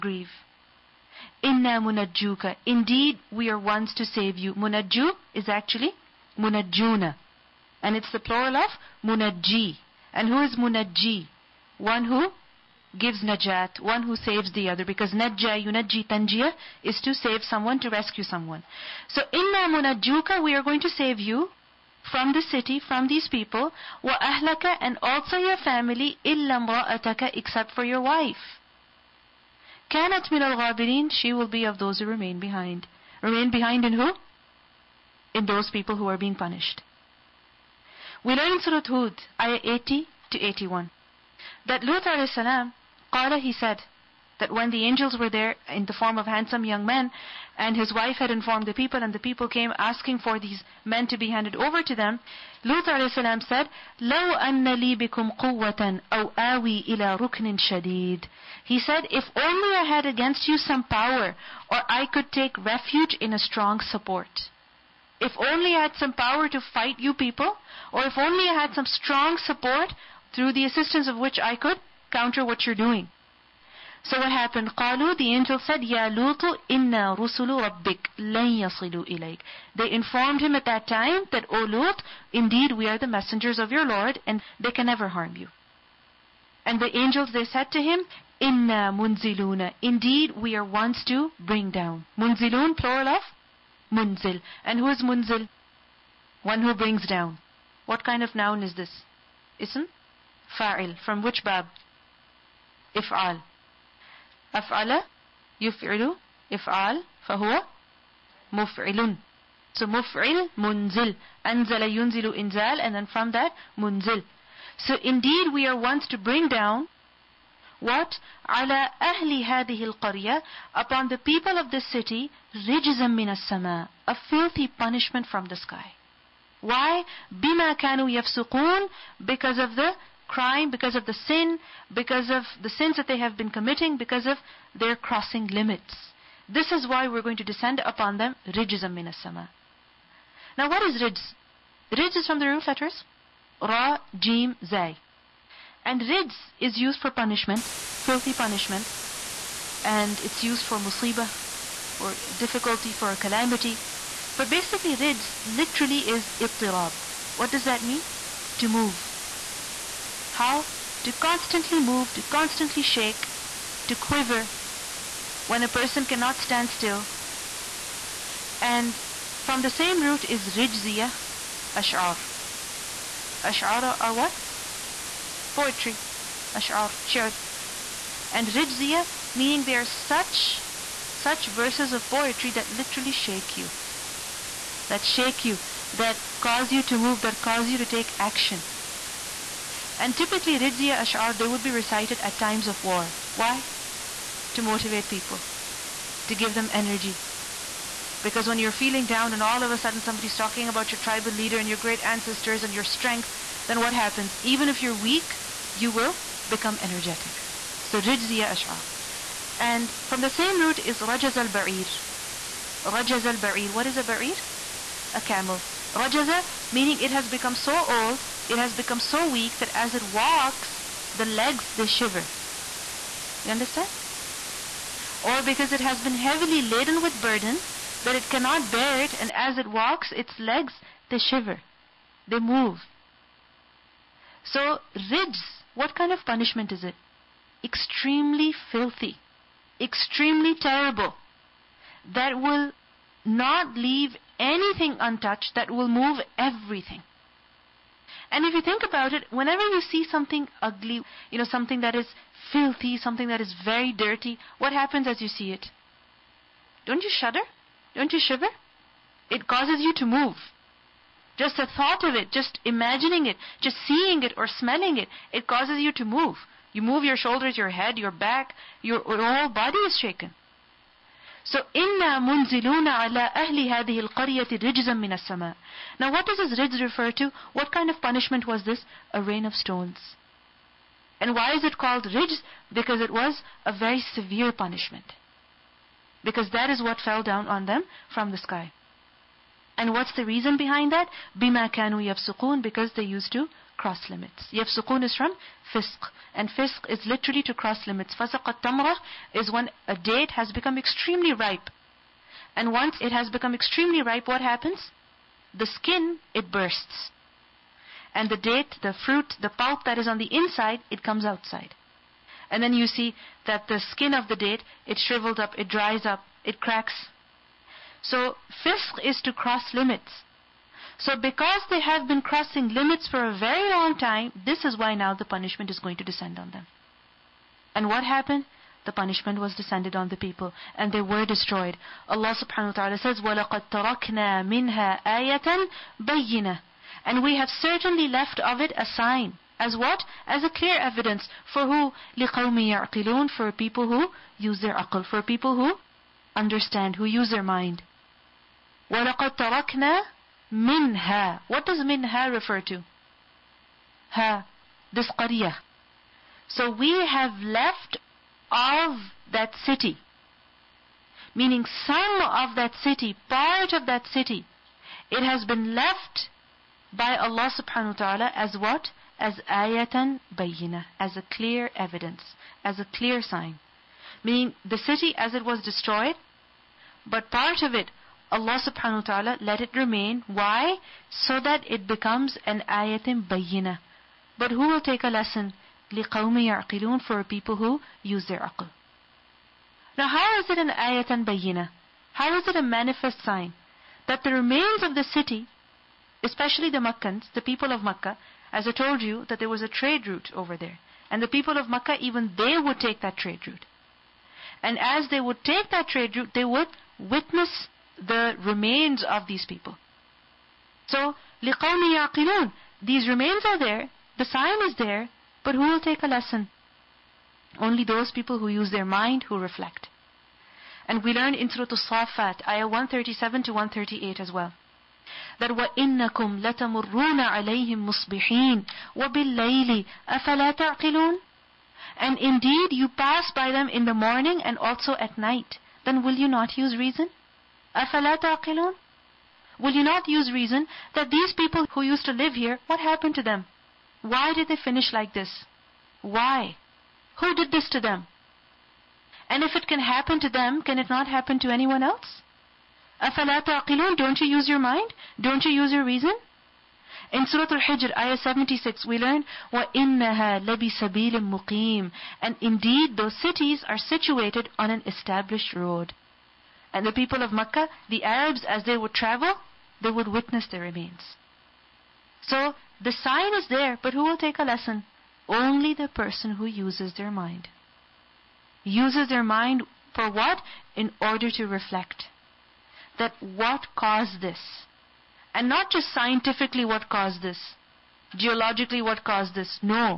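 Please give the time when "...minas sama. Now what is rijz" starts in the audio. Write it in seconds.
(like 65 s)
138 s.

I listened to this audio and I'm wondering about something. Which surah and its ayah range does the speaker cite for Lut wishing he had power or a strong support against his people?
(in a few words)
Surah Hud, 80 to 81.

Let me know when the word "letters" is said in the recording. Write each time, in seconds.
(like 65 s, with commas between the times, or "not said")
142 s.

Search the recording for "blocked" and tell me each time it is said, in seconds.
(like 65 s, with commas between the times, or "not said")
not said.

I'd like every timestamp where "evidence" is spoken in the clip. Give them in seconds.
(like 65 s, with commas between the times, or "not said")
340 s, 371 s.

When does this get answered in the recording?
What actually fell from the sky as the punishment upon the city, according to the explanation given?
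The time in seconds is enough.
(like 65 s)
279 s.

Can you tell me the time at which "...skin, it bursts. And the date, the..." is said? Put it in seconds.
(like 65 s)
305 s.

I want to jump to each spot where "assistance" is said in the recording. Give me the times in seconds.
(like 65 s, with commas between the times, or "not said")
70 s.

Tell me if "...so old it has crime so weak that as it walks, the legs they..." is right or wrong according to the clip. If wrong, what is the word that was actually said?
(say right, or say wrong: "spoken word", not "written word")
wrong: "become", not "crime".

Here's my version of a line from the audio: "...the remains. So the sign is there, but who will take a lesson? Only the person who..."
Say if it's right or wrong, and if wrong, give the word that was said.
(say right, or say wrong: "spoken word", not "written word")
right.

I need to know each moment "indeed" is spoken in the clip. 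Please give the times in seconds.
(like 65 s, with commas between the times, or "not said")
2 s, 82 s, 89 s, 115 s, 432 s, 462 s.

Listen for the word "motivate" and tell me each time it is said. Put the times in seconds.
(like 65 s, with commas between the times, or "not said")
194 s.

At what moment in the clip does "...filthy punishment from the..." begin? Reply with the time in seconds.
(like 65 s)
124 s.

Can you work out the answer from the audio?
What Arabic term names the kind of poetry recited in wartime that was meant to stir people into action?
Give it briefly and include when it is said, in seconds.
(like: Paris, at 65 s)
Rijziya ash'ar, at 170 s.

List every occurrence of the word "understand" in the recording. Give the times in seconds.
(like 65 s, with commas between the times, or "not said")
223 s, 346 s.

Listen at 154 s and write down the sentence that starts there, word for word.
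But basically rijz literally is ittirab.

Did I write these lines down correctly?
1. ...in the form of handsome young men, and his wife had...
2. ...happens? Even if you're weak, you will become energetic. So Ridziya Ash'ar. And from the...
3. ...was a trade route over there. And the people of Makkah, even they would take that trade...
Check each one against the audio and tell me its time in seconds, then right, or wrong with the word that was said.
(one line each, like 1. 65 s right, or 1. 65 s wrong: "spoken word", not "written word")
1. 45 s right
2. 203 s right
3. 399 s right.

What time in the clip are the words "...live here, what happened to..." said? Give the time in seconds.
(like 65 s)
442 s.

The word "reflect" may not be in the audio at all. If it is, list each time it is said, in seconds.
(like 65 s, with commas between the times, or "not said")
419 s, 481 s.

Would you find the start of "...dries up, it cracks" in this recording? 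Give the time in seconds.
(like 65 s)
315 s.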